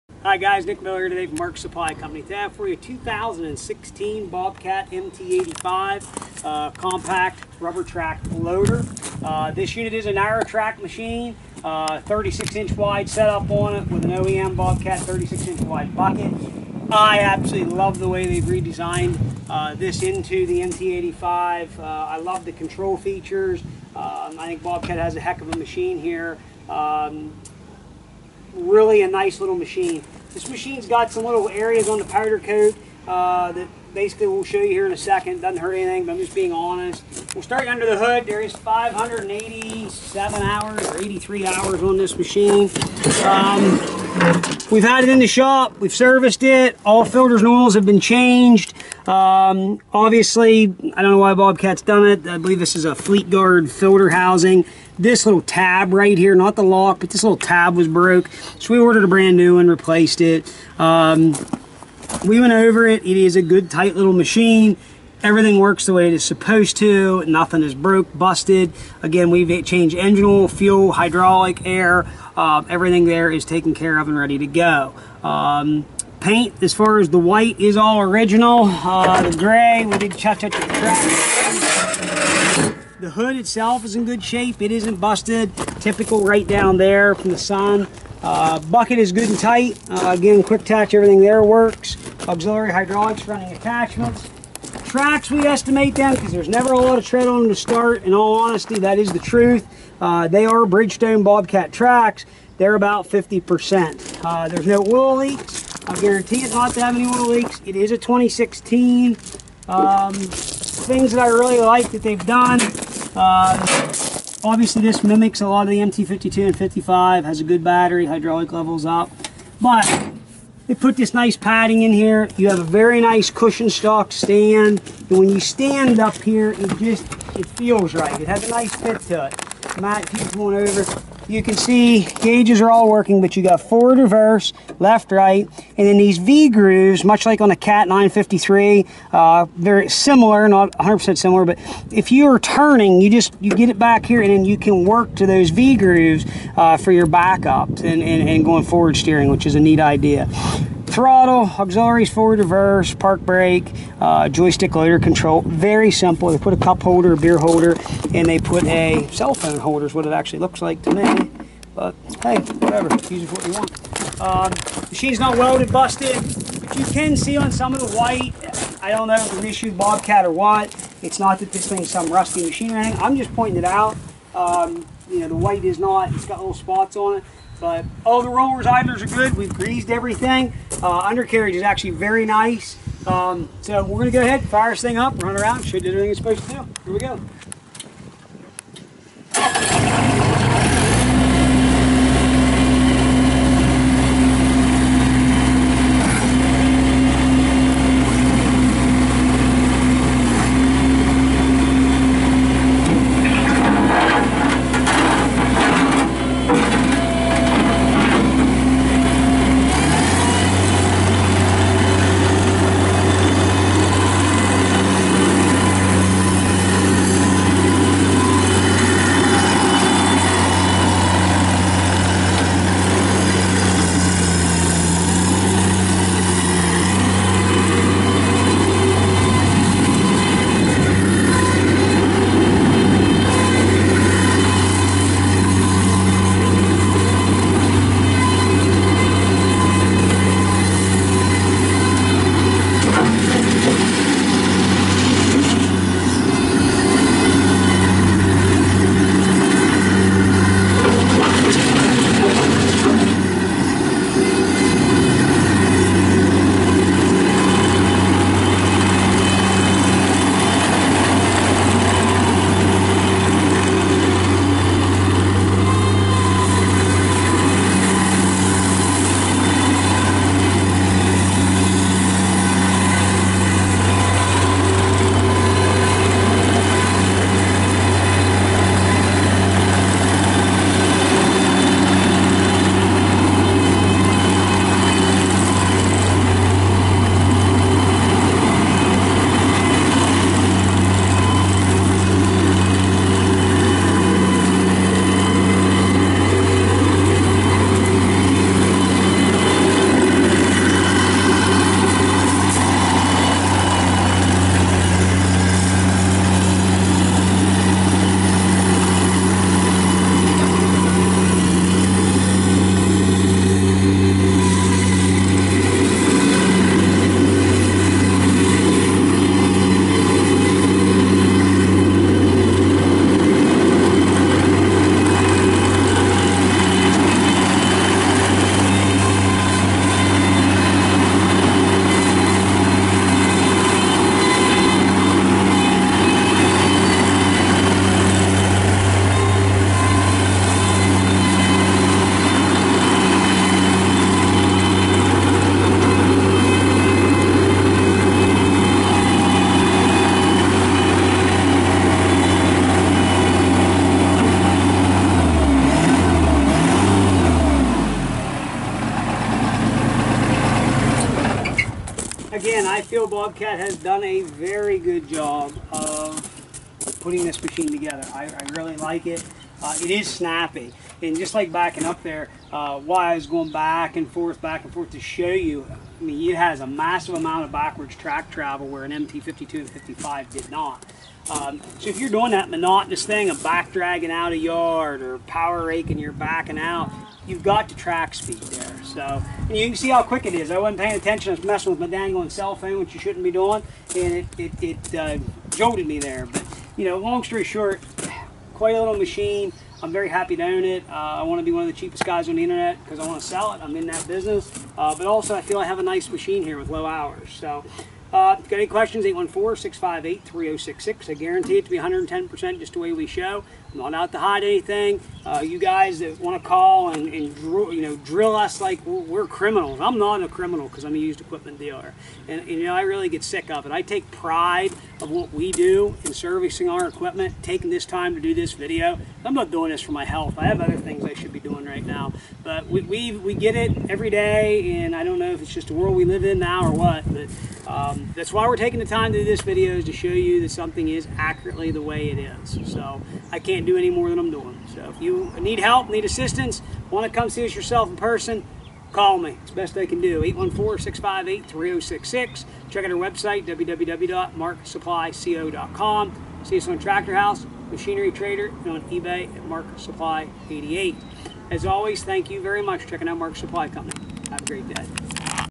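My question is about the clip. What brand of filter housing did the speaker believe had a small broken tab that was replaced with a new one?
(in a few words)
Fleetguard.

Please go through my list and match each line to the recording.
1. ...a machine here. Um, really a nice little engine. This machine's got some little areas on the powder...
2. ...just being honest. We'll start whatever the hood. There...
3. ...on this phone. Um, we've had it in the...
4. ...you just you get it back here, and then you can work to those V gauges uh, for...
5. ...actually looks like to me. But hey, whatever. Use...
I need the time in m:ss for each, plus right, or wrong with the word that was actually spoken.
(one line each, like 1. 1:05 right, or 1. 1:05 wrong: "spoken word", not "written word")
1. 0:25 wrong: "machine", not "engine"
2. 0:36 wrong: "under", not "whatever"
3. 0:41 wrong: "machine", not "phone"
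4. 2:23 wrong: "grooves", not "gauges"
5. 2:40 right.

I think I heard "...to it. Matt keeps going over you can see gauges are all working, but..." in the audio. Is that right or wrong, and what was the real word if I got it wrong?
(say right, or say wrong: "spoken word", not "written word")
right.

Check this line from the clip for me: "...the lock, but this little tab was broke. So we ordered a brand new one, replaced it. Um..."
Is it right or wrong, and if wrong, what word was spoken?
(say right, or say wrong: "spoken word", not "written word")
right.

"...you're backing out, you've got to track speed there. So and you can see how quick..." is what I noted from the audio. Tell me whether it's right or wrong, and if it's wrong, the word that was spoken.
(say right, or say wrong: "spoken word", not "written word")
right.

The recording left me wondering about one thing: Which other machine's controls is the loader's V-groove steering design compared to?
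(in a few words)
Cat 953.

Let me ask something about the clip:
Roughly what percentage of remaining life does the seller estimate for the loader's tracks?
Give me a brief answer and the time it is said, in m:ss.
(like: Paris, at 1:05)
50%, at 1:42.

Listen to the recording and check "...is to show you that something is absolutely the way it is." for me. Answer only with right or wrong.
wrong.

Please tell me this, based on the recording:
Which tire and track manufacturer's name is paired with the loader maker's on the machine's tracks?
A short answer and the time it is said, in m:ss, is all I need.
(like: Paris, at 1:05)
Bridgestone, at 1:40.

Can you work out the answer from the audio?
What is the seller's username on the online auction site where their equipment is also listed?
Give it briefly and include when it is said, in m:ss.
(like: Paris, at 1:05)
Mark Supply 88, at 7:39.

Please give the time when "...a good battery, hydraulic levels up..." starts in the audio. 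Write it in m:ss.
1:57.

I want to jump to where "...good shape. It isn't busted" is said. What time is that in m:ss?
1:24.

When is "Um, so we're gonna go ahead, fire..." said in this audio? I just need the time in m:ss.
3:03.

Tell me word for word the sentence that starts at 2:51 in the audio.
It's not that this thing's some rusty machine or anything.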